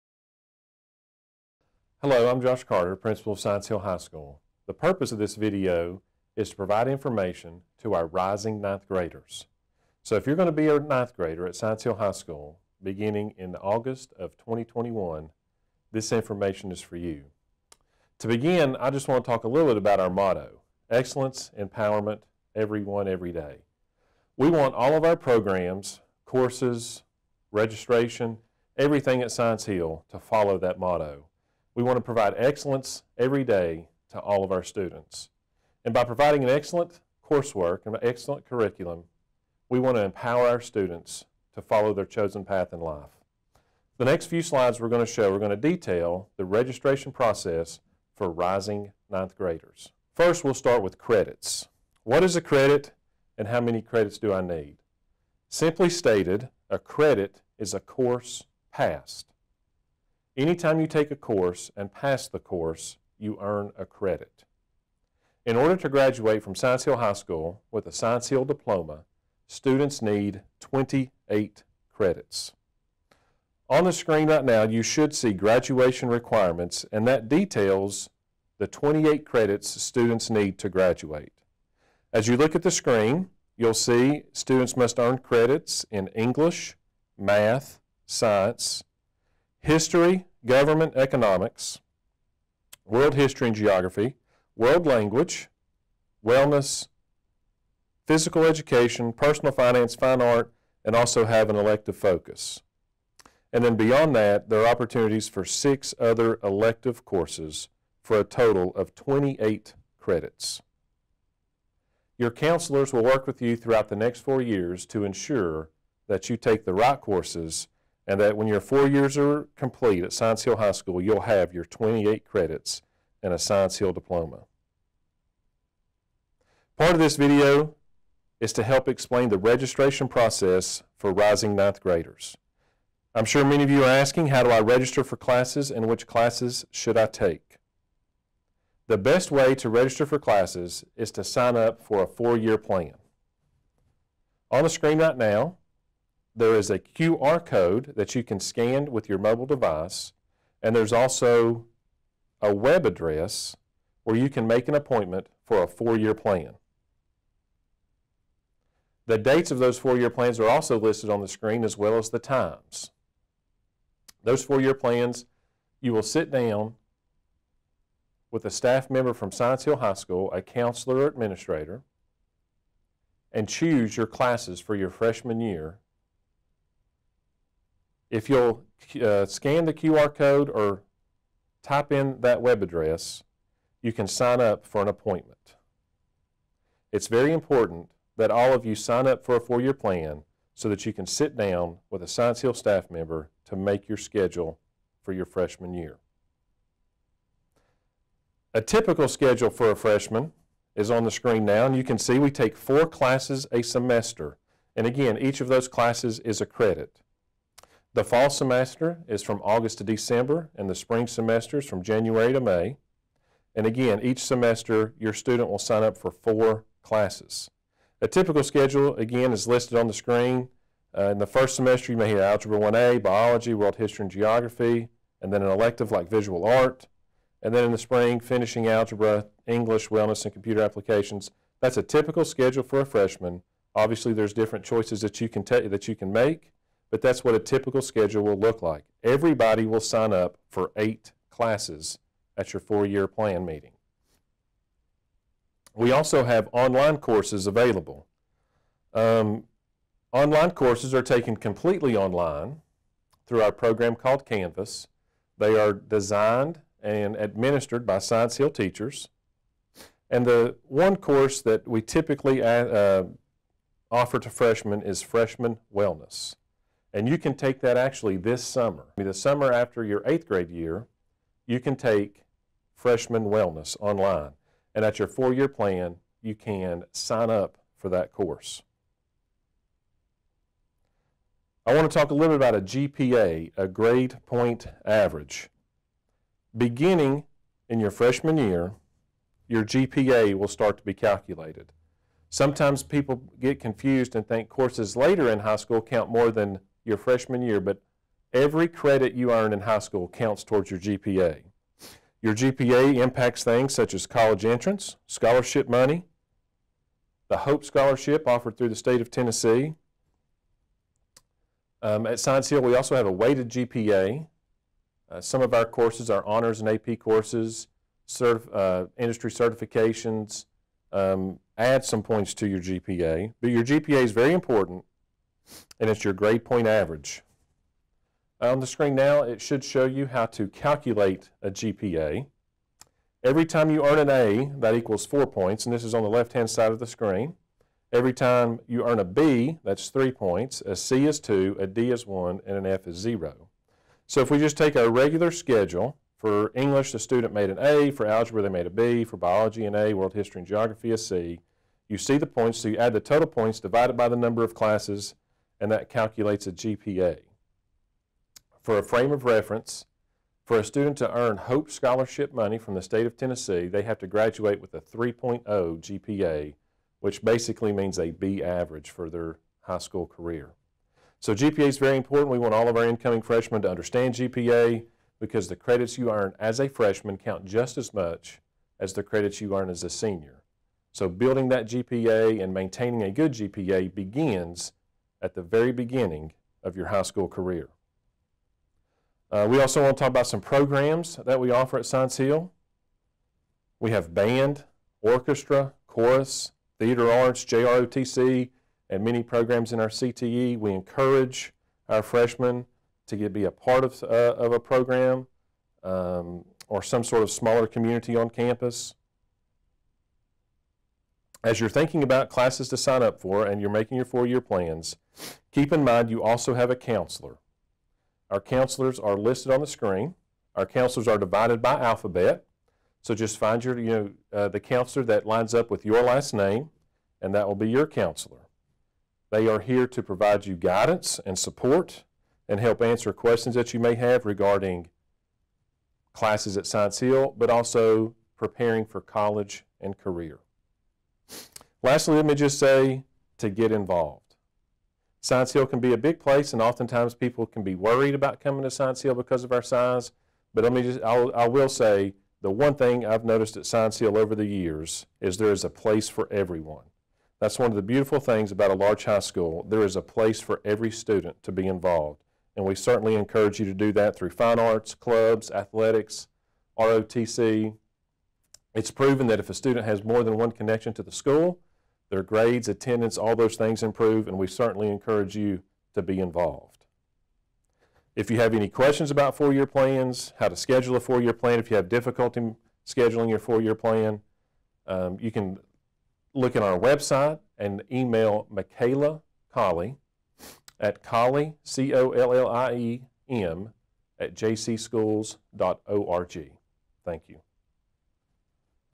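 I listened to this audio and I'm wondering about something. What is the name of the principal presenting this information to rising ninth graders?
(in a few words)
Josh Carter.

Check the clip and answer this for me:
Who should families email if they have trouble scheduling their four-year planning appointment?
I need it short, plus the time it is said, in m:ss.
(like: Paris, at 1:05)
Michaela Collie, at 8:08.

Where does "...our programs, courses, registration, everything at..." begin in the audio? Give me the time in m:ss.
0:25.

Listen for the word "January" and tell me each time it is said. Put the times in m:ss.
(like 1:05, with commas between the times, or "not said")
3:31.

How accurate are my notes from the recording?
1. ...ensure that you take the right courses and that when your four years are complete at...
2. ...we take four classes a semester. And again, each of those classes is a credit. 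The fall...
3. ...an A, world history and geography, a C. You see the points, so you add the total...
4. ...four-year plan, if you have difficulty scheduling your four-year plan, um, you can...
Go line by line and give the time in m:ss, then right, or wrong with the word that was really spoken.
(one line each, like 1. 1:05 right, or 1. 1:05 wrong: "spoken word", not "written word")
1. 1:55 right
2. 3:22 right
3. 5:49 right
4. 8:00 right.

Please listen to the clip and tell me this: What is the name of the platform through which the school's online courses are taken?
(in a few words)
Canvas.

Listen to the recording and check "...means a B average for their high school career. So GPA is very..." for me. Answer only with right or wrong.
right.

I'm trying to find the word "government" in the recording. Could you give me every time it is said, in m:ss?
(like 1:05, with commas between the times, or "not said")
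1:30.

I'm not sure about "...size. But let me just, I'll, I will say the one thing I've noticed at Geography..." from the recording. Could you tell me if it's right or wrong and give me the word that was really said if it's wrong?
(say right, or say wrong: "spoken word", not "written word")
wrong: "Science", not "Geography".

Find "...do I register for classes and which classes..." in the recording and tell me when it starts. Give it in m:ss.
2:14.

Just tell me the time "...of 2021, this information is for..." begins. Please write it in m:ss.
0:14.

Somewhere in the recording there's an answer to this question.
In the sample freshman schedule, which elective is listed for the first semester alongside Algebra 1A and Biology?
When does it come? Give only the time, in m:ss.
3:46.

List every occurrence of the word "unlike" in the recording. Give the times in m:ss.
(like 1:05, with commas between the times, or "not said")
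not said.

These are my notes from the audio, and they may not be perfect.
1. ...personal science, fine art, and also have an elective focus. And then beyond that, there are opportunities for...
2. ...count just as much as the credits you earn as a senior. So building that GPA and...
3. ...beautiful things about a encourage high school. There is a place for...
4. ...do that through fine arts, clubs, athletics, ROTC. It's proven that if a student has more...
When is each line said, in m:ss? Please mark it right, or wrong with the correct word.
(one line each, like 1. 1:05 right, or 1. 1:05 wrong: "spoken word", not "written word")
1. 1:39 wrong: "finance", not "science"
2. 6:17 right
3. 7:37 wrong: "large", not "encourage"
4. 7:43 right.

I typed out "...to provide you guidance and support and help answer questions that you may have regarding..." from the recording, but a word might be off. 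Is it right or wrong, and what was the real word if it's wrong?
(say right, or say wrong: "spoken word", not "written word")
right.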